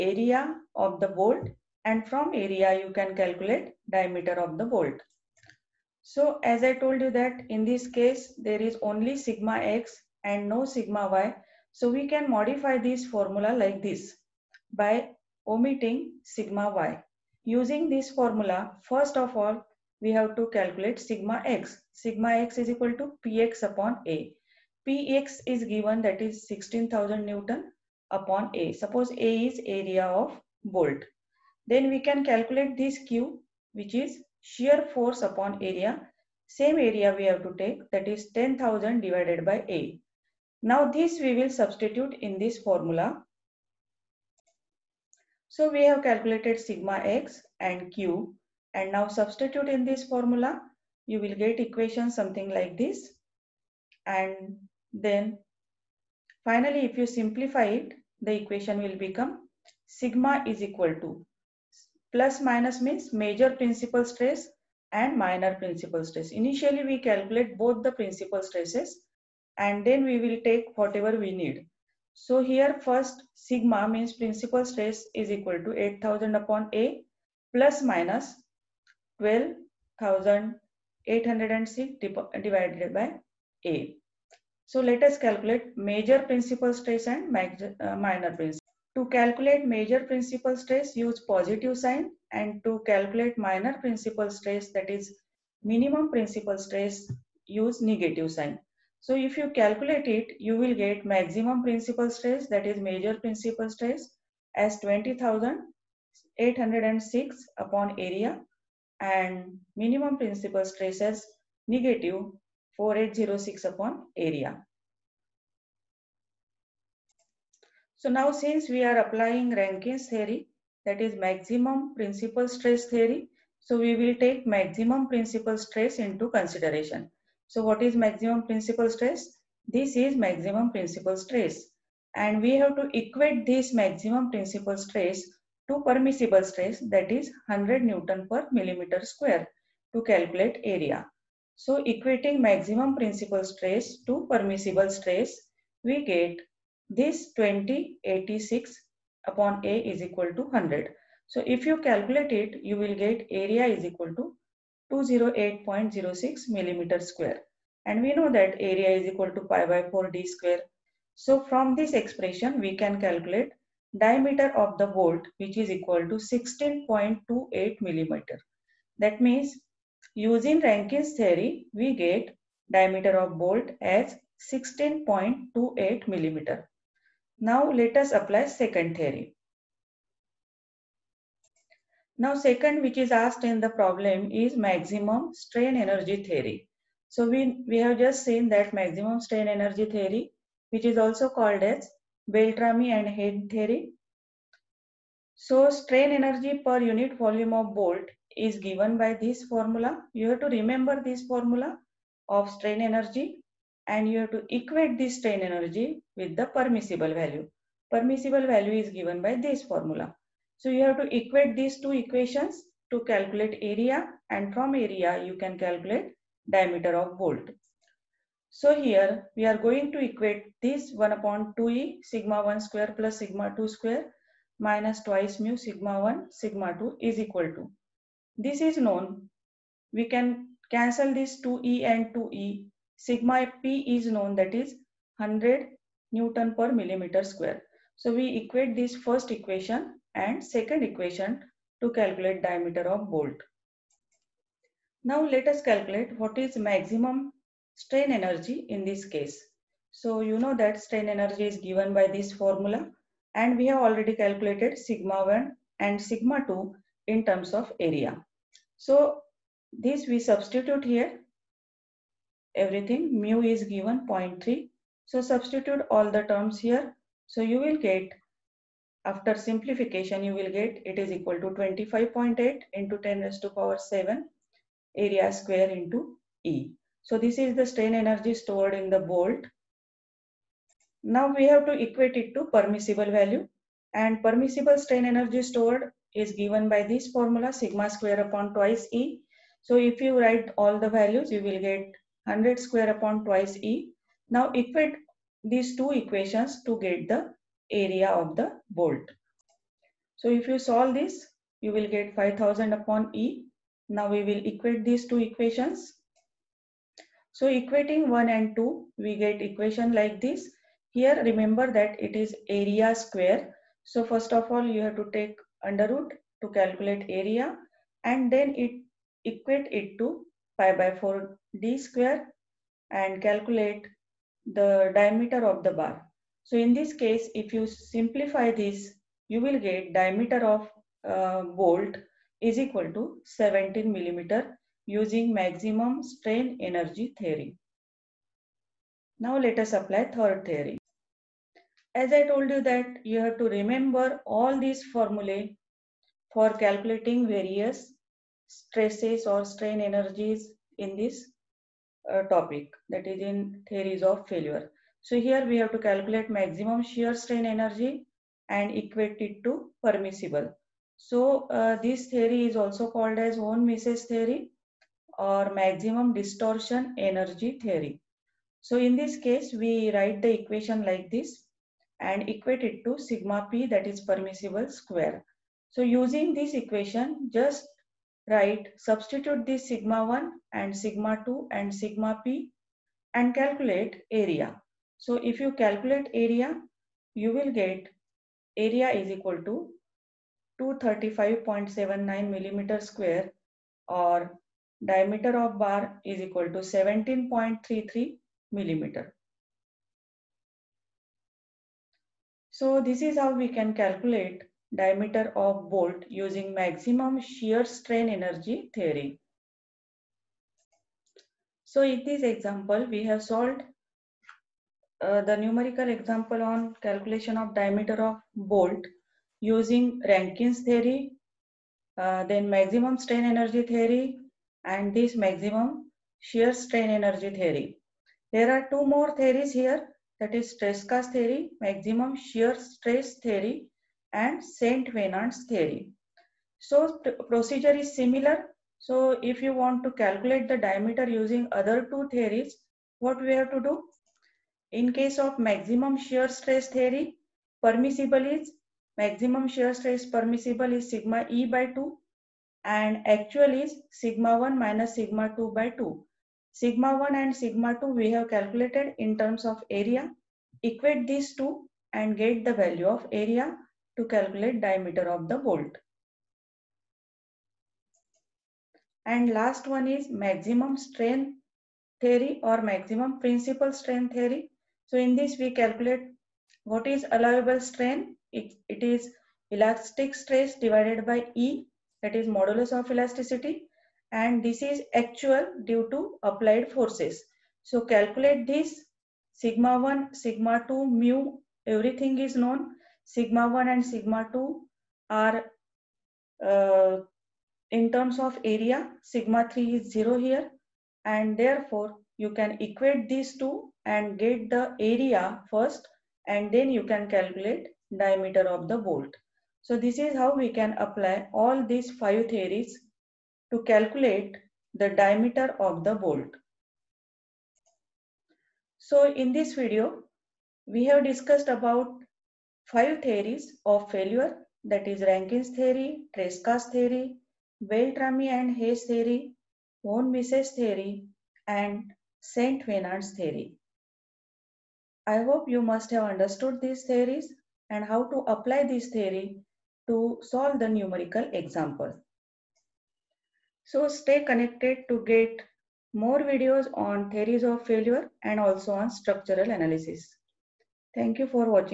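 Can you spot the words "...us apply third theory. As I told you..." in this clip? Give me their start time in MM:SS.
05:39.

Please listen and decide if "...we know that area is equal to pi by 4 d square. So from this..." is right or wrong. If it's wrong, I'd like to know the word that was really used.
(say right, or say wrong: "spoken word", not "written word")
right.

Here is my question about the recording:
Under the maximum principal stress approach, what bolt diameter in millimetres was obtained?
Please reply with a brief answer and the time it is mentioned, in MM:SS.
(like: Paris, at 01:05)
16.28 mm, at 02:46.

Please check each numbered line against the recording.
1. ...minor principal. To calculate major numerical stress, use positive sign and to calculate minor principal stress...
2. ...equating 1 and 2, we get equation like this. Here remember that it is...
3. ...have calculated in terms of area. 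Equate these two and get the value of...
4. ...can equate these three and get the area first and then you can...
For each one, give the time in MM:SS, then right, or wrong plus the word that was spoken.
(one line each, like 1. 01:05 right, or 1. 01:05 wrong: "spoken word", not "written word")
1. 01:27 wrong: "principal", not "numerical"
2. 05:07 right
3. 07:38 right
4. 08:22 wrong: "two", not "three".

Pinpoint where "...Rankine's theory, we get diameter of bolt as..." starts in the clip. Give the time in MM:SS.
02:50.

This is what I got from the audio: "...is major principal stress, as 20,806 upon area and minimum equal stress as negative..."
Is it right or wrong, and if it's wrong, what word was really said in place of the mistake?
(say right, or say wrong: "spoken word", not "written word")
wrong: "principal", not "equal".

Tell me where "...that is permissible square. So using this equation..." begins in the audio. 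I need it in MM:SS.
06:13.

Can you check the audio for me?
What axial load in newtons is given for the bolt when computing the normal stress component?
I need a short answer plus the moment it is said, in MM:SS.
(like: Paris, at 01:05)
16,000 N, at 00:26.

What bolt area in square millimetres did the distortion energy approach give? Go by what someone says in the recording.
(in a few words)
235.79 mm².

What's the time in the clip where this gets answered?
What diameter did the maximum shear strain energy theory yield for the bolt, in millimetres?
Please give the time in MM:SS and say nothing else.
06:36.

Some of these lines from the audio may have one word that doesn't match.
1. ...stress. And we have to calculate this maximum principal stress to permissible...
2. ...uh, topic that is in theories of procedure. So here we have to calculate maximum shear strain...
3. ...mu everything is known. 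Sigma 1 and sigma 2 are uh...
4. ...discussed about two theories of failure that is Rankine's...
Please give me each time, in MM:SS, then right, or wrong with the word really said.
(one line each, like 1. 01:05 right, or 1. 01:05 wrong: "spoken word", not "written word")
1. 02:11 wrong: "equate", not "calculate"
2. 05:52 wrong: "failure", not "procedure"
3. 08:10 right
4. 08:41 wrong: "five", not "two".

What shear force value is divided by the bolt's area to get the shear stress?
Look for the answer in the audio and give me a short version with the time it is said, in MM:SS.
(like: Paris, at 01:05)
10,000, at 00:38.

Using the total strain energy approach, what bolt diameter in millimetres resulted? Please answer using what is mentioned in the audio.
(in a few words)
17 mm.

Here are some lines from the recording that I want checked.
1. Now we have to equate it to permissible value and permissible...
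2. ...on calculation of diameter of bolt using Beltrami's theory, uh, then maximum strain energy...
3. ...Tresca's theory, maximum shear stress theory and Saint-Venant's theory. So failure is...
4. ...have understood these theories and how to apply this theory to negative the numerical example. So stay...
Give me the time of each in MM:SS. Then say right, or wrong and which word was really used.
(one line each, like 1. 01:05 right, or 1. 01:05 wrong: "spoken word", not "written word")
1. 04:41 right
2. 06:56 wrong: "Rankine", not "Beltrami"
3. 07:10 wrong: "procedure", not "failure"
4. 08:55 wrong: "solve", not "negative".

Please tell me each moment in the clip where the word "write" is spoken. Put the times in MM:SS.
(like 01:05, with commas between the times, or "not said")
04:50, 06:09, 06:18.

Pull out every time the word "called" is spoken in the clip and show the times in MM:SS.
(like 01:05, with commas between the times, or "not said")
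03:11, 06:02.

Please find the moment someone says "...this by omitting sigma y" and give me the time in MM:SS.
00:13.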